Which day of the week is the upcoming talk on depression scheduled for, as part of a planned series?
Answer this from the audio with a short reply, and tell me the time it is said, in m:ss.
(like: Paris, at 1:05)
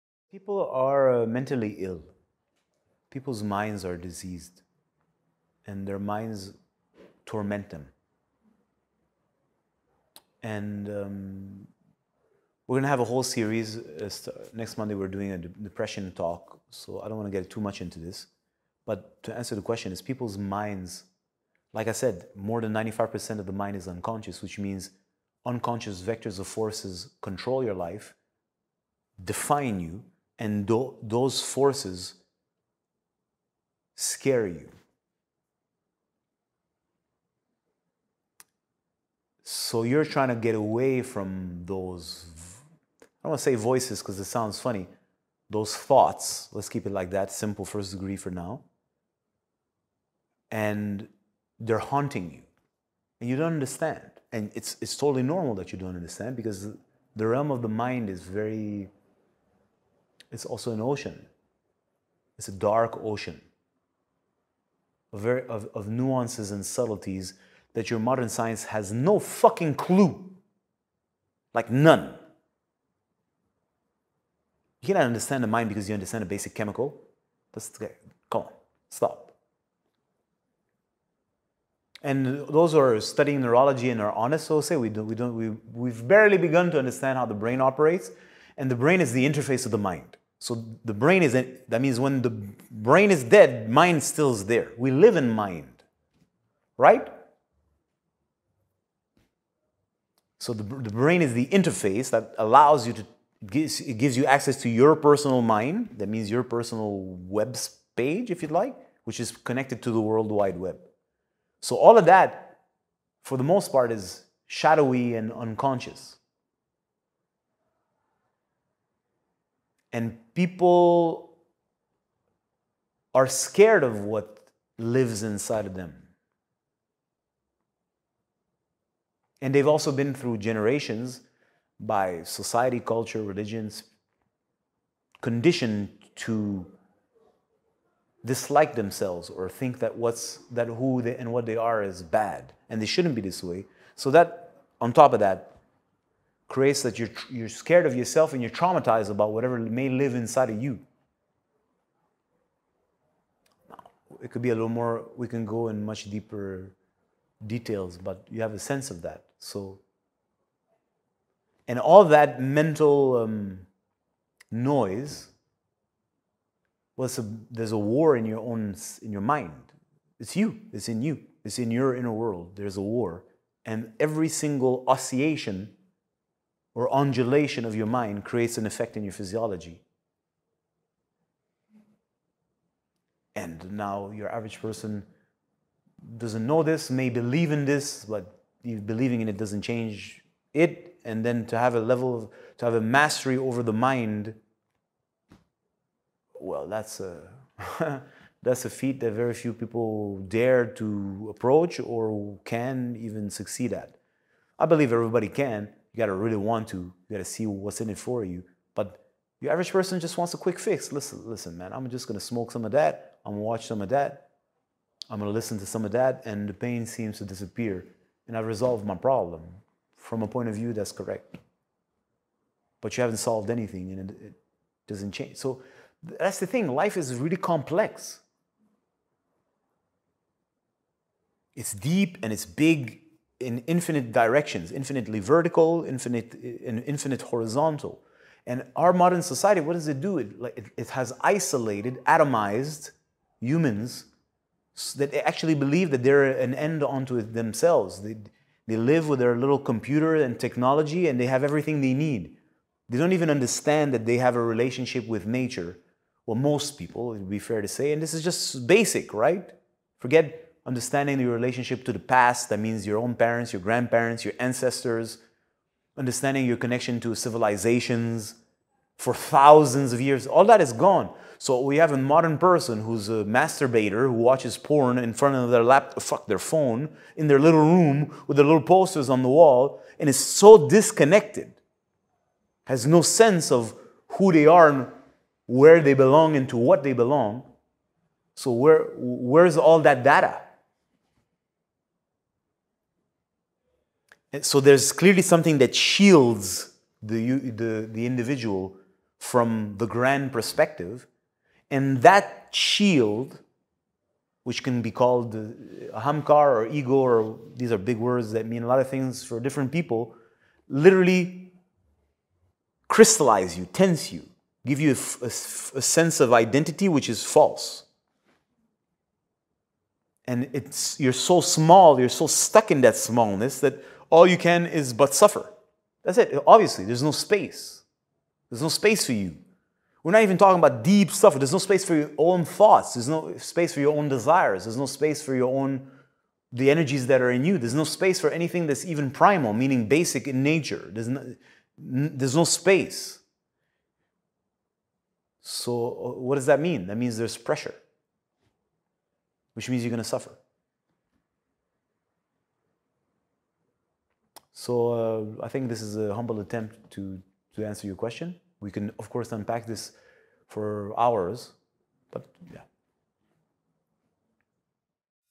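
Monday, at 0:14.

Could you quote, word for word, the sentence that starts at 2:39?
So, and all that mental um, noise, well, a, there's a war in your own, in your mind.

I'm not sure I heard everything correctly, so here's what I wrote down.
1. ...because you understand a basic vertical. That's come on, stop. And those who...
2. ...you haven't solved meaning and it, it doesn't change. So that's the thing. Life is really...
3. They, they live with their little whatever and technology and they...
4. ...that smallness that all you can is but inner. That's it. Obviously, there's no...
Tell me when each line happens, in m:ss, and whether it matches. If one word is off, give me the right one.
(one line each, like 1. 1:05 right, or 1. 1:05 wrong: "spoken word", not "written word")
1. 1:15 wrong: "chemical", not "vertical"
2. 3:42 wrong: "anything", not "meaning"
3. 4:08 wrong: "computer", not "whatever"
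4. 5:22 wrong: "suffer", not "inner".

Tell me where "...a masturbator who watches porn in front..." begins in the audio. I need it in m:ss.
4:33.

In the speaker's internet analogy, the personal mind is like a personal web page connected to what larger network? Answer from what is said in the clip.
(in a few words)
World Wide Web.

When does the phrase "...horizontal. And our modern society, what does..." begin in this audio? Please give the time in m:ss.
3:57.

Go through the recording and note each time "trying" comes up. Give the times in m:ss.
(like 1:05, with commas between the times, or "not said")
0:40.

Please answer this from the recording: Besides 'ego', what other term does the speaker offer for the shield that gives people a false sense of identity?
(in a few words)
hamkar.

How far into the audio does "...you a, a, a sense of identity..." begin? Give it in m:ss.
5:14.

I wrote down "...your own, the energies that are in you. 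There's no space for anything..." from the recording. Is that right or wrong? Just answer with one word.
right.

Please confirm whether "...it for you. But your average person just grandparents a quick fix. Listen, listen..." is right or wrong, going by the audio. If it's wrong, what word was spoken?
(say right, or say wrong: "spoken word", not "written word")
wrong: "wants", not "grandparents".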